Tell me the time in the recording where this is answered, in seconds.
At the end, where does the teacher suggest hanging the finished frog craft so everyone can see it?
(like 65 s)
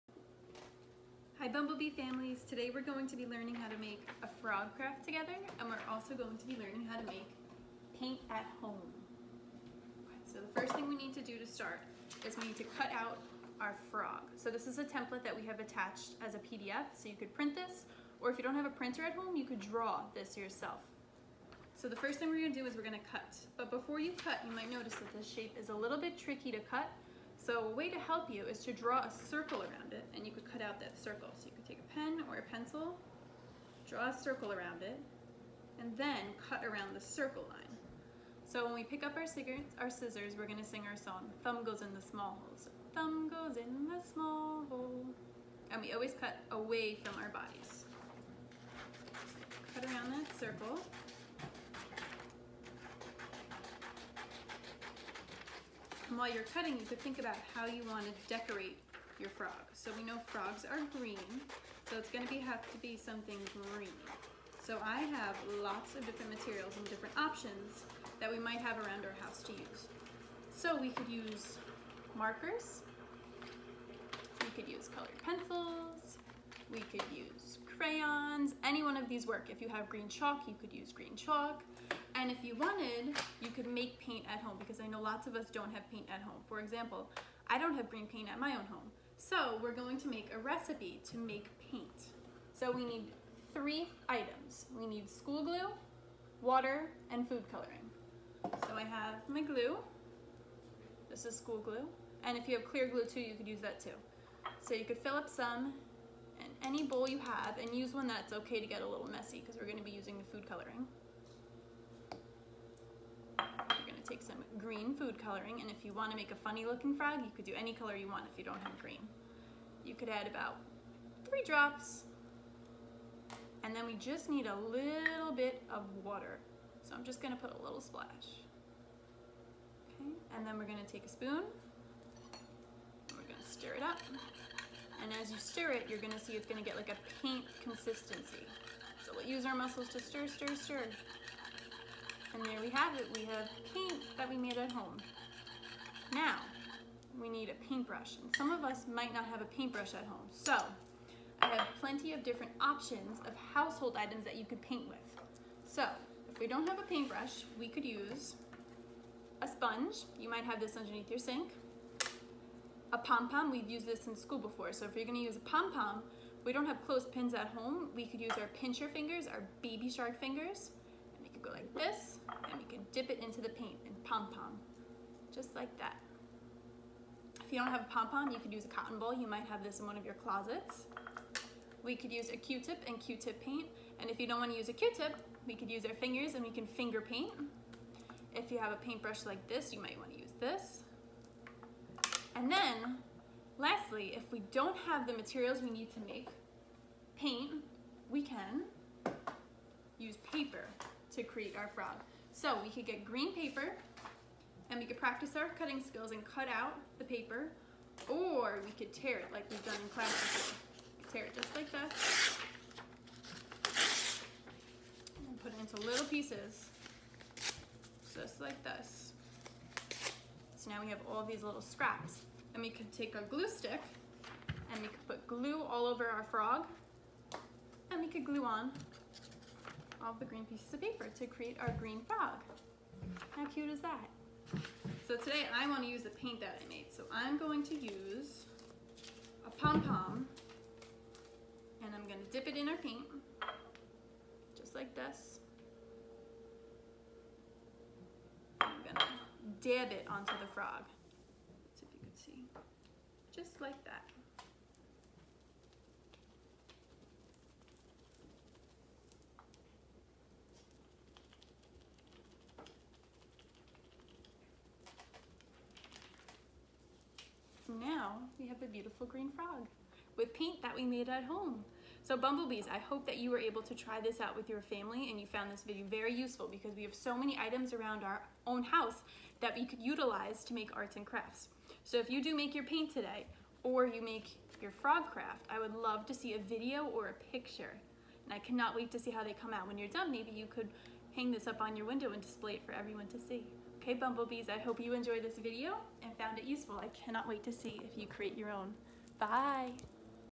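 291 s.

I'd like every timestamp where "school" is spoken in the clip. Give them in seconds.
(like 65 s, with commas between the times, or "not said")
95 s, 101 s, 164 s.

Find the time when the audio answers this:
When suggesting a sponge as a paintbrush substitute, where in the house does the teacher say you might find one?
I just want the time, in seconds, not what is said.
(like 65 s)
160 s.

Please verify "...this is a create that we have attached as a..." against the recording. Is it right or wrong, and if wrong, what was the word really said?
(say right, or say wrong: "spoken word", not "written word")
wrong: "template", not "create".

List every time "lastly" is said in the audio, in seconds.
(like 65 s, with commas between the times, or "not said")
193 s.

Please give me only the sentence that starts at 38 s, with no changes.
So when we pick up our, our scissors, we're gonna sing our song, Thumb Goes in the Small Hole.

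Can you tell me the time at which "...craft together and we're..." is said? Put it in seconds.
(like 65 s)
4 s.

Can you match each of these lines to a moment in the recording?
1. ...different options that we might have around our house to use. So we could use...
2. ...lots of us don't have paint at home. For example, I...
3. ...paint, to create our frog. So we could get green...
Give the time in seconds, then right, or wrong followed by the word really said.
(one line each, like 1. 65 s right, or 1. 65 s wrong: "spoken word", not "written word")
1. 66 s right
2. 85 s right
3. 197 s right.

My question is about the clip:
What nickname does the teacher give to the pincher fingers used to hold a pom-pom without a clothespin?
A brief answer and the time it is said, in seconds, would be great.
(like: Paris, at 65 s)
Baby shark fingers, at 169 s.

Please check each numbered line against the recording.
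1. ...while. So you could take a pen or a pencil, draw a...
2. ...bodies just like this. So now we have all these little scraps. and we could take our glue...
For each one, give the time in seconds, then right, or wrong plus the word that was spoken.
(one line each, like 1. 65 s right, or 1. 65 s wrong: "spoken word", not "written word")
1. 30 s wrong: "circle", not "while"
2. 216 s wrong: "pieces", not "bodies".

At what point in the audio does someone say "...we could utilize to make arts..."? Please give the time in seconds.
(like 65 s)
279 s.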